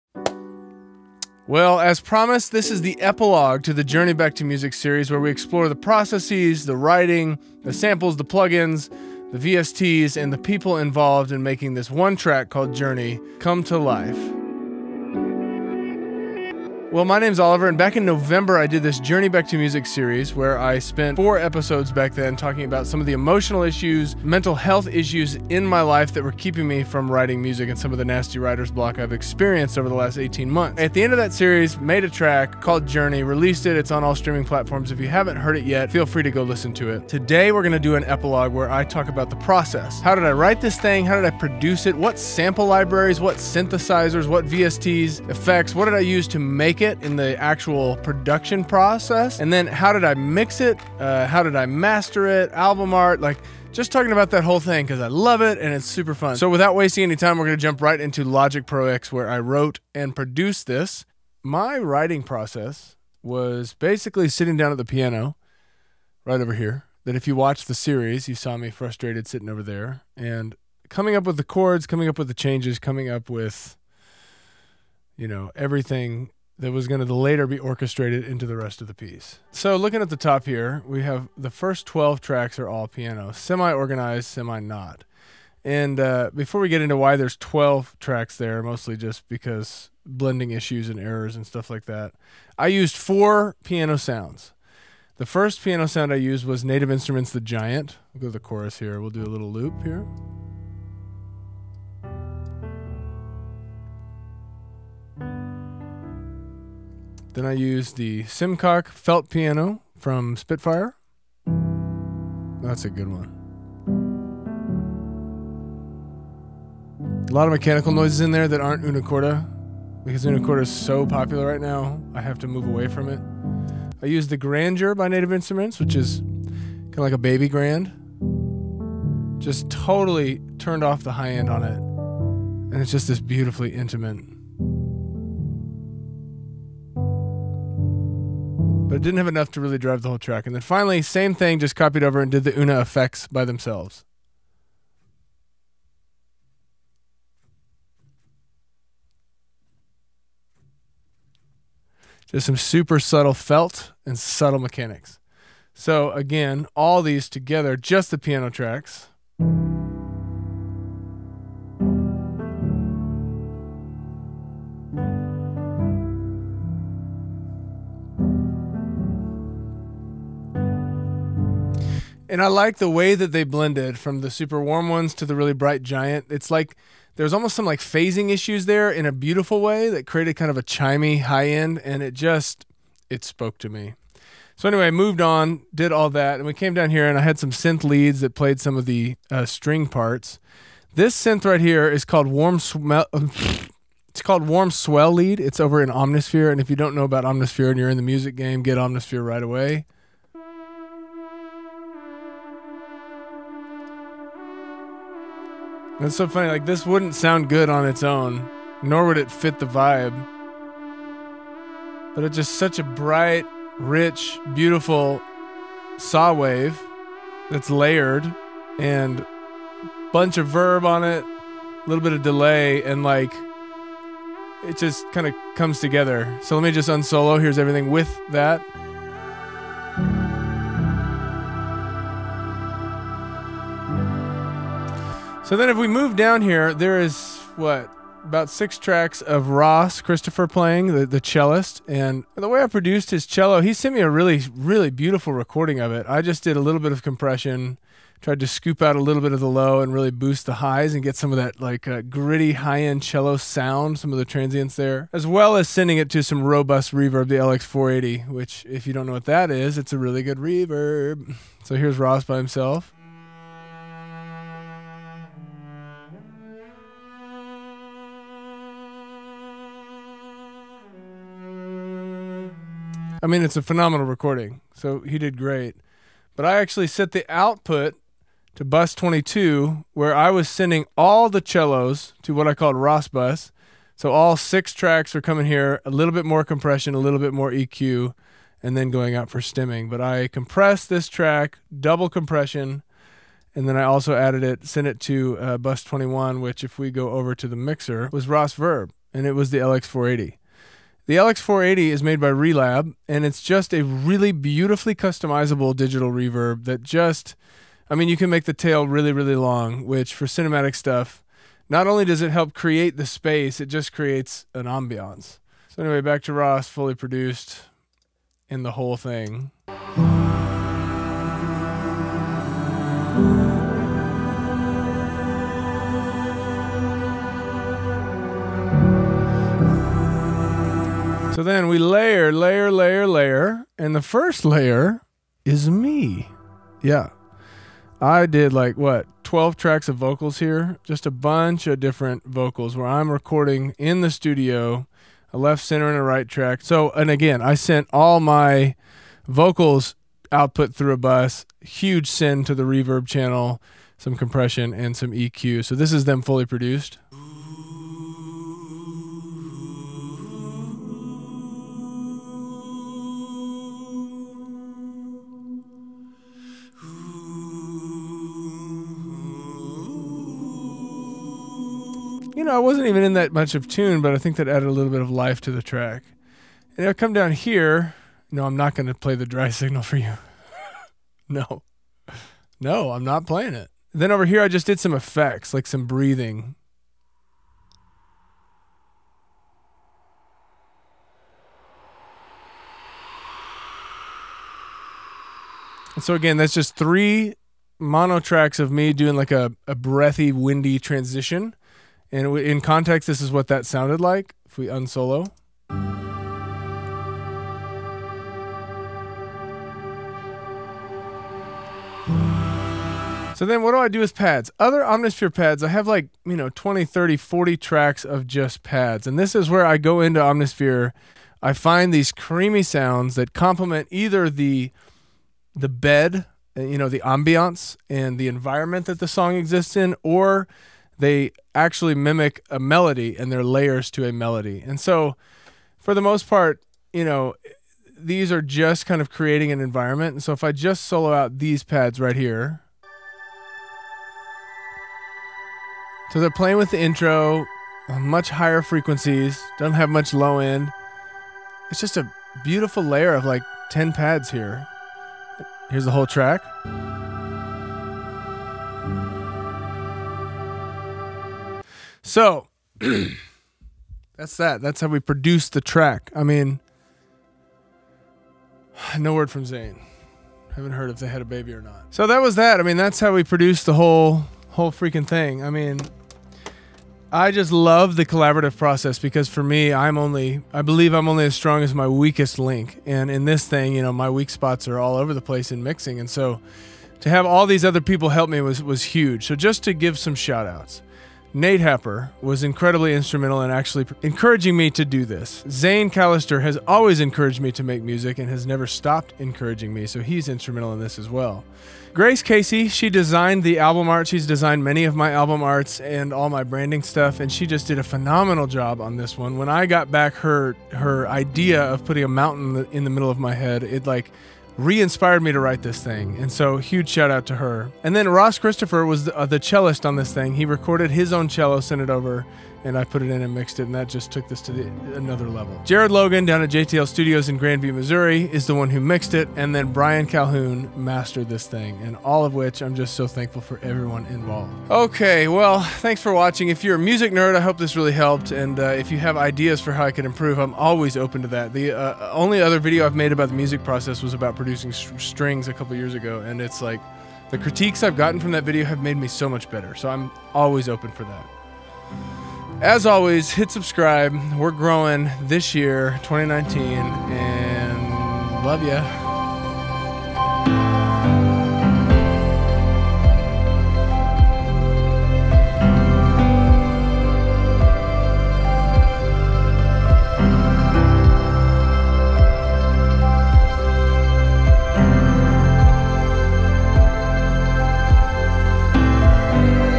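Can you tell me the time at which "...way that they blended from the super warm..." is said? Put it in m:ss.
2:52.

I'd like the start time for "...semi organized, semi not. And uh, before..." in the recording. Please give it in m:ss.
1:23.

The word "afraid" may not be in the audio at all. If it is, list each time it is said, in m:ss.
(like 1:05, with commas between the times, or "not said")
not said.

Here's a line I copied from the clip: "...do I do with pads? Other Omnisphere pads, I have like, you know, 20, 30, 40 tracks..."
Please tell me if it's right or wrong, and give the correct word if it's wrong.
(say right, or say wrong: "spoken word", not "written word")
right.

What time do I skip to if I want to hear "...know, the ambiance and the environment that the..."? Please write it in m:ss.
7:06.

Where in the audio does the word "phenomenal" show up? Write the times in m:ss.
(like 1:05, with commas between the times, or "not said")
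4:33, 8:27.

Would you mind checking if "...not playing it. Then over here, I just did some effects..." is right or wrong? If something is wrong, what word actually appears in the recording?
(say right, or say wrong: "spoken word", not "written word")
right.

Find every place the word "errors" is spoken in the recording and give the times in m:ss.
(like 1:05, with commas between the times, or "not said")
1:30.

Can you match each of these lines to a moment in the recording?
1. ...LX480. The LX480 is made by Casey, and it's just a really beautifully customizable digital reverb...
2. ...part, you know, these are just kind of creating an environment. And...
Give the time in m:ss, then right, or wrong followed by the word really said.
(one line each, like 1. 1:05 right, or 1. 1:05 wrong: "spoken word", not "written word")
1. 4:59 wrong: "Relab", not "Casey"
2. 7:16 right.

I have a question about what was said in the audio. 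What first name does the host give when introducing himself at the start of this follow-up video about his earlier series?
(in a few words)
Oliver.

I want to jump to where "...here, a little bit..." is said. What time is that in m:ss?
4:45.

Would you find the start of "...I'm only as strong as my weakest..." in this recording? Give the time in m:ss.
8:00.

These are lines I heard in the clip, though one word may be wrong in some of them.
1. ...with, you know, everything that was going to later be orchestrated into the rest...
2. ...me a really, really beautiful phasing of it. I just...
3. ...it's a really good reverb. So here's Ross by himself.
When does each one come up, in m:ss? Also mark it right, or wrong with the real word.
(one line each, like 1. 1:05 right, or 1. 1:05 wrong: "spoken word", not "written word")
1. 1:13 right
2. 4:03 wrong: "recording", not "phasing"
3. 4:19 right.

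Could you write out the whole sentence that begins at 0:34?
If you haven't heard it yet, feel free to go listen to it.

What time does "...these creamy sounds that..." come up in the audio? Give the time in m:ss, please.
7:01.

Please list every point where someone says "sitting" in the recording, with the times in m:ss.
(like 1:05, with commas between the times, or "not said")
1:04, 1:09.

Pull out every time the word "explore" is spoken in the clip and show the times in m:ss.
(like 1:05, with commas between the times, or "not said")
0:05.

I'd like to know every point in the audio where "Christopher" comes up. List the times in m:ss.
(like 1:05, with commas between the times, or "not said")
3:59, 8:38.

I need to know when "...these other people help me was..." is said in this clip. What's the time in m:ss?
8:07.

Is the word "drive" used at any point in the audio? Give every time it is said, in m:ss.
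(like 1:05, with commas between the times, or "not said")
2:19.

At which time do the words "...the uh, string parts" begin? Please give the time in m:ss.
3:08.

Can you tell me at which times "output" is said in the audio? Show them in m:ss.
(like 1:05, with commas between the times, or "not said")
4:37, 5:50.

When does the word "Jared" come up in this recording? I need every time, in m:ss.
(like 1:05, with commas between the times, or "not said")
8:45.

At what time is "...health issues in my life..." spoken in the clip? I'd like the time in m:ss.
0:24.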